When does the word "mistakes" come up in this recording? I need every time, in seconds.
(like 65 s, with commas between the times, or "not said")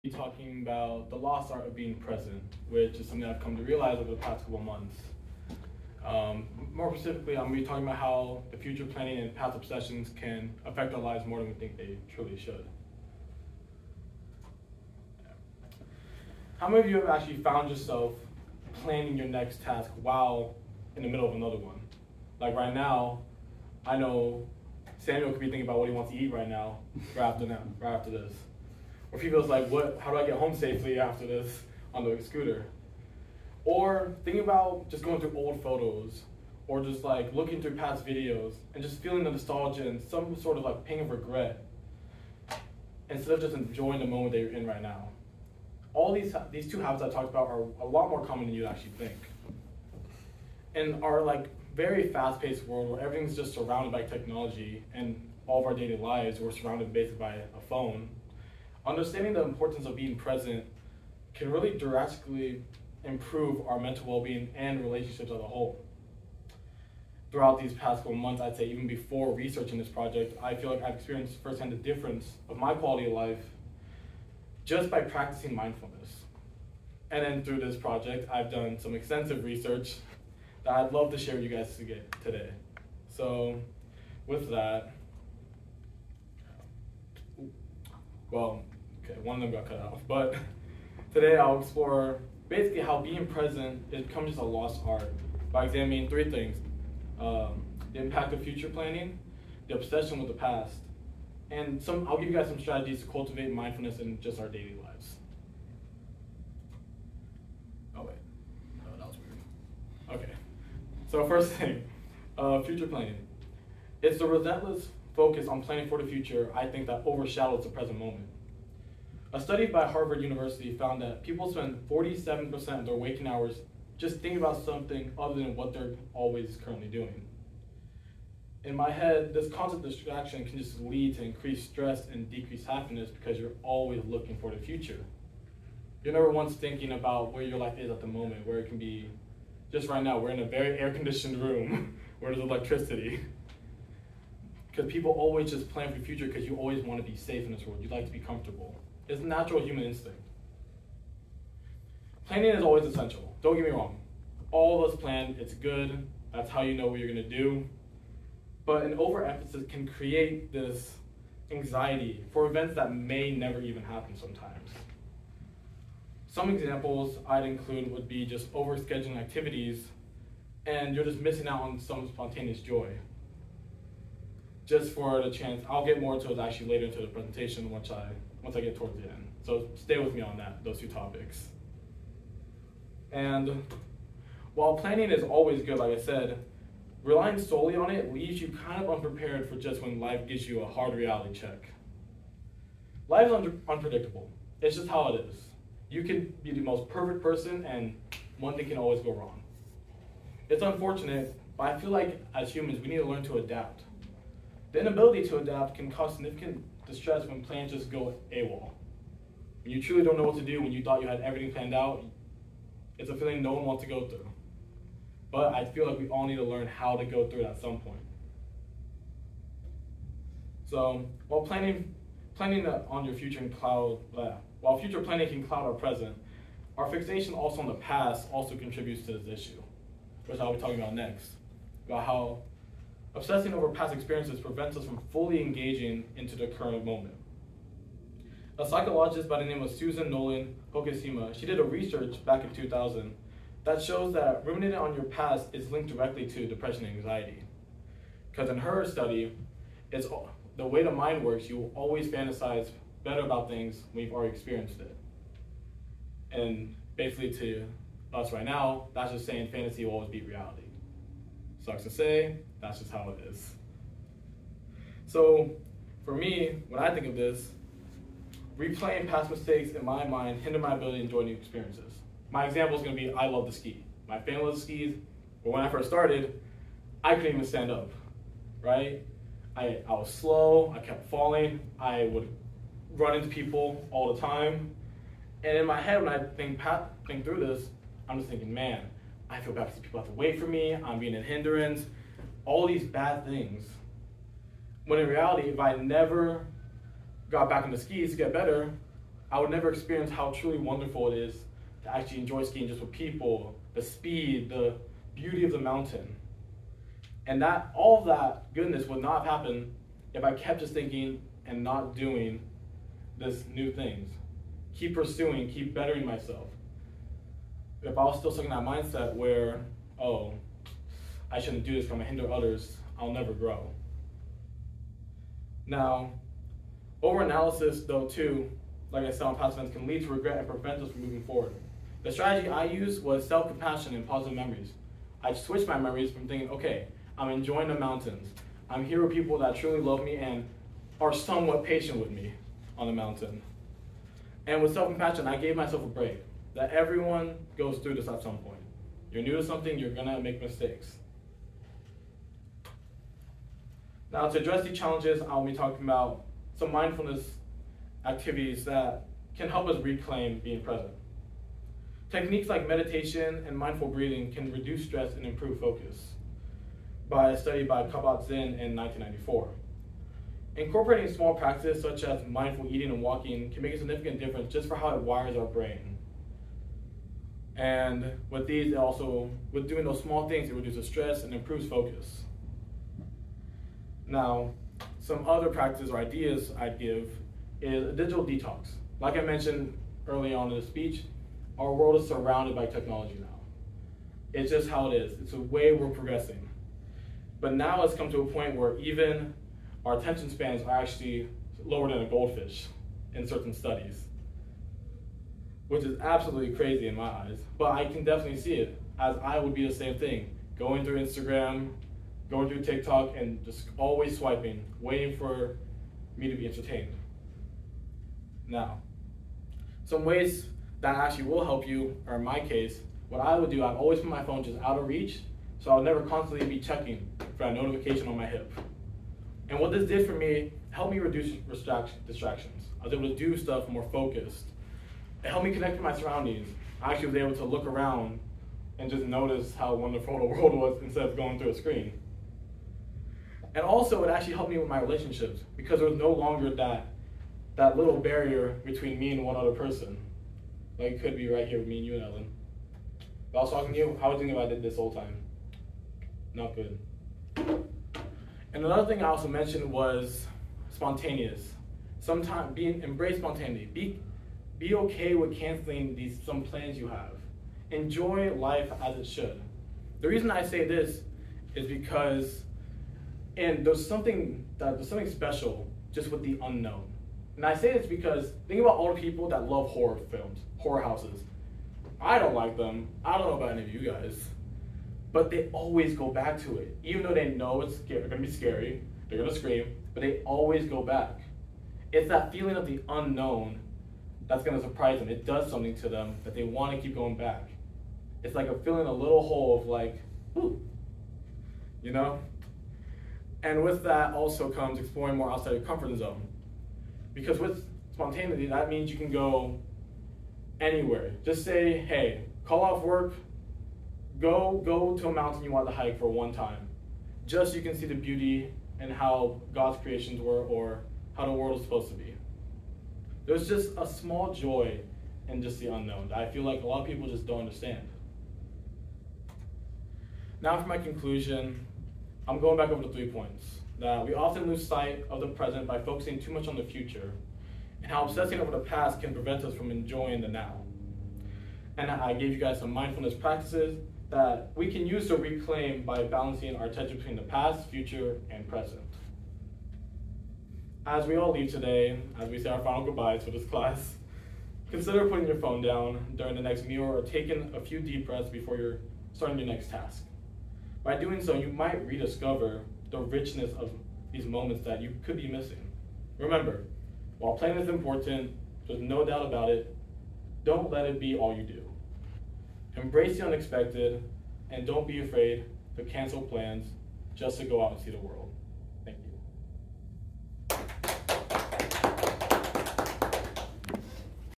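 269 s, 350 s.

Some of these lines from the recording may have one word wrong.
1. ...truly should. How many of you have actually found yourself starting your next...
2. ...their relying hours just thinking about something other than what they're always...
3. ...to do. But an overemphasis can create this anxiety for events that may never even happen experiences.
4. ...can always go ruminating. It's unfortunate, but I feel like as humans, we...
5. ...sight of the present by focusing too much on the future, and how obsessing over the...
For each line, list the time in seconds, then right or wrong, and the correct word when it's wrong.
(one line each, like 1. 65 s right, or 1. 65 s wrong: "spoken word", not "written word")
1. 12 s wrong: "planning", not "starting"
2. 122 s wrong: "waking", not "relying"
3. 157 s wrong: "sometimes", not "experiences"
4. 198 s wrong: "wrong", not "ruminating"
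5. 534 s right.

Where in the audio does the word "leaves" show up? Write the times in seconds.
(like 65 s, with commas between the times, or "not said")
188 s, 551 s.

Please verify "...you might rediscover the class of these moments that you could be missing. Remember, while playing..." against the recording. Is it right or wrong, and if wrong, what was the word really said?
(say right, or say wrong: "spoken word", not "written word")
wrong: "richness", not "class".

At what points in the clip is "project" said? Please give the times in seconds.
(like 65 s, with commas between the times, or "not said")
69 s, 77 s.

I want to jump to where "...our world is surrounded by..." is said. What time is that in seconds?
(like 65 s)
391 s.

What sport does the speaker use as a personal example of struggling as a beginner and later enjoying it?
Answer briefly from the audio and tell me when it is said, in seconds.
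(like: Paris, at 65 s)
Skiing, at 273 s.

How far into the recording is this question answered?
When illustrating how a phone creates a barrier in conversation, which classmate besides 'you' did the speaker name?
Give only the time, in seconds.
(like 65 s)
452 s.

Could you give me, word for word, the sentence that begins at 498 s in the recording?
It's like a filling a little hole of like, ooh, you know?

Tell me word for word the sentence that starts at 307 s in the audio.
And that all that goodness would not have happened if I kept just thinking and not doing this new things.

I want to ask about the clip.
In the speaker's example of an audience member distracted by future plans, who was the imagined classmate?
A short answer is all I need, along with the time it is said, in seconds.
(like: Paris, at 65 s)
Samuel, at 24 s.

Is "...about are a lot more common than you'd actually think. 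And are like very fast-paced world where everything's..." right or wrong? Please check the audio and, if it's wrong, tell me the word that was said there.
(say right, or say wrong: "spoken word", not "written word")
right.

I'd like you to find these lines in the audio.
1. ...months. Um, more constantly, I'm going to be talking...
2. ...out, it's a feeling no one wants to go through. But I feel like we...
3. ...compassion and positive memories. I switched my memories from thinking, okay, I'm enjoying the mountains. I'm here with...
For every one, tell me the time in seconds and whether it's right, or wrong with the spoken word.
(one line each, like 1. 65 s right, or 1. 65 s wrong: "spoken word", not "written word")
1. 4 s wrong: "specifically", not "constantly"
2. 211 s right
3. 333 s right.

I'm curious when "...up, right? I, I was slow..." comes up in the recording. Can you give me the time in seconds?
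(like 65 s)
277 s.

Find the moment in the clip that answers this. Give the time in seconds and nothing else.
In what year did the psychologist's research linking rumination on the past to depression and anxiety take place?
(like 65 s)
242 s.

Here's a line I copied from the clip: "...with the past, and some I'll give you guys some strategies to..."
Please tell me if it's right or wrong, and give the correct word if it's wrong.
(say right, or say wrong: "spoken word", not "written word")
right.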